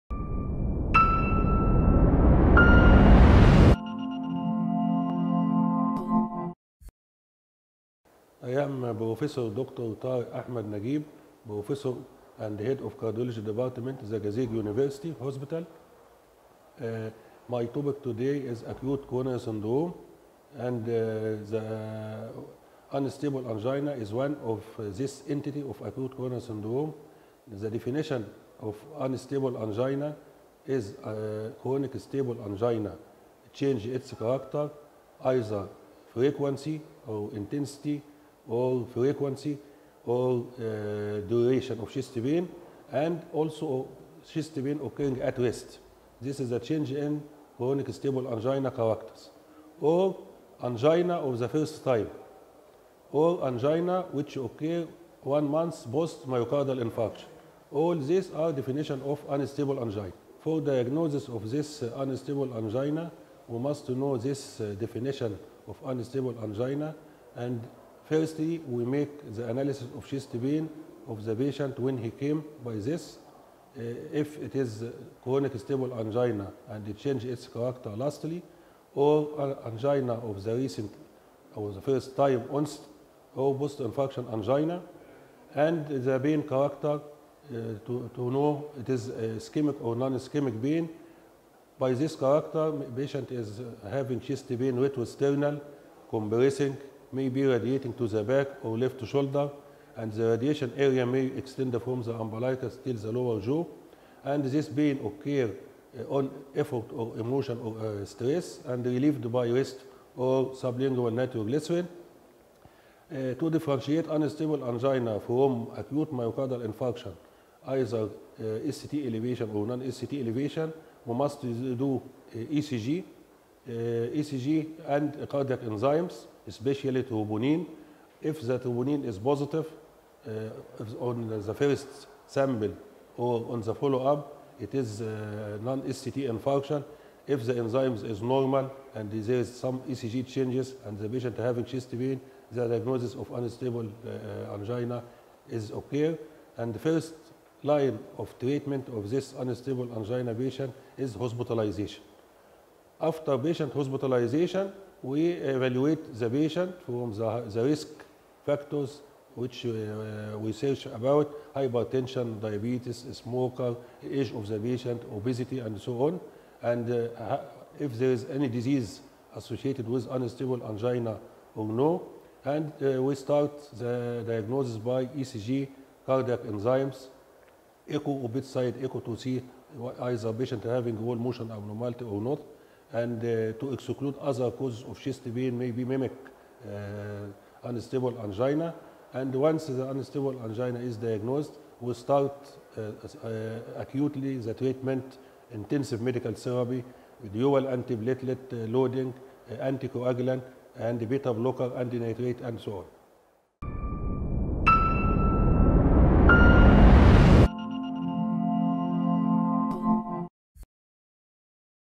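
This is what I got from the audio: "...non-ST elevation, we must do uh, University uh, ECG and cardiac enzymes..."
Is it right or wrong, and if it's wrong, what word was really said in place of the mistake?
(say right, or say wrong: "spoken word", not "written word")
wrong: "ECG", not "University".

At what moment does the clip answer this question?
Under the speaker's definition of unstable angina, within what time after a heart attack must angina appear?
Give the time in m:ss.
0:55.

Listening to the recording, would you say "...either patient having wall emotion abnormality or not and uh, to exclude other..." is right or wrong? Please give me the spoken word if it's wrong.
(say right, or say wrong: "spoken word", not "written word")
wrong: "motion", not "emotion".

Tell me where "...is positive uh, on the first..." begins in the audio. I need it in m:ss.
2:09.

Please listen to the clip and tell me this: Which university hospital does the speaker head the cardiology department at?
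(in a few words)
Zagazig University Hospital.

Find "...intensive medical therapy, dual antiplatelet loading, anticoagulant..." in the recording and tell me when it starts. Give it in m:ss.
3:15.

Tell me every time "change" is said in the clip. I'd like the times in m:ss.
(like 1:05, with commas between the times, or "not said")
0:33, 0:46, 1:16, 2:20.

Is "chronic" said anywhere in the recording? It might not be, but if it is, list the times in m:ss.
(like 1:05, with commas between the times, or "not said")
0:31, 0:47, 1:15.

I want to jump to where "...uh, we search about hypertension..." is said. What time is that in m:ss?
2:39.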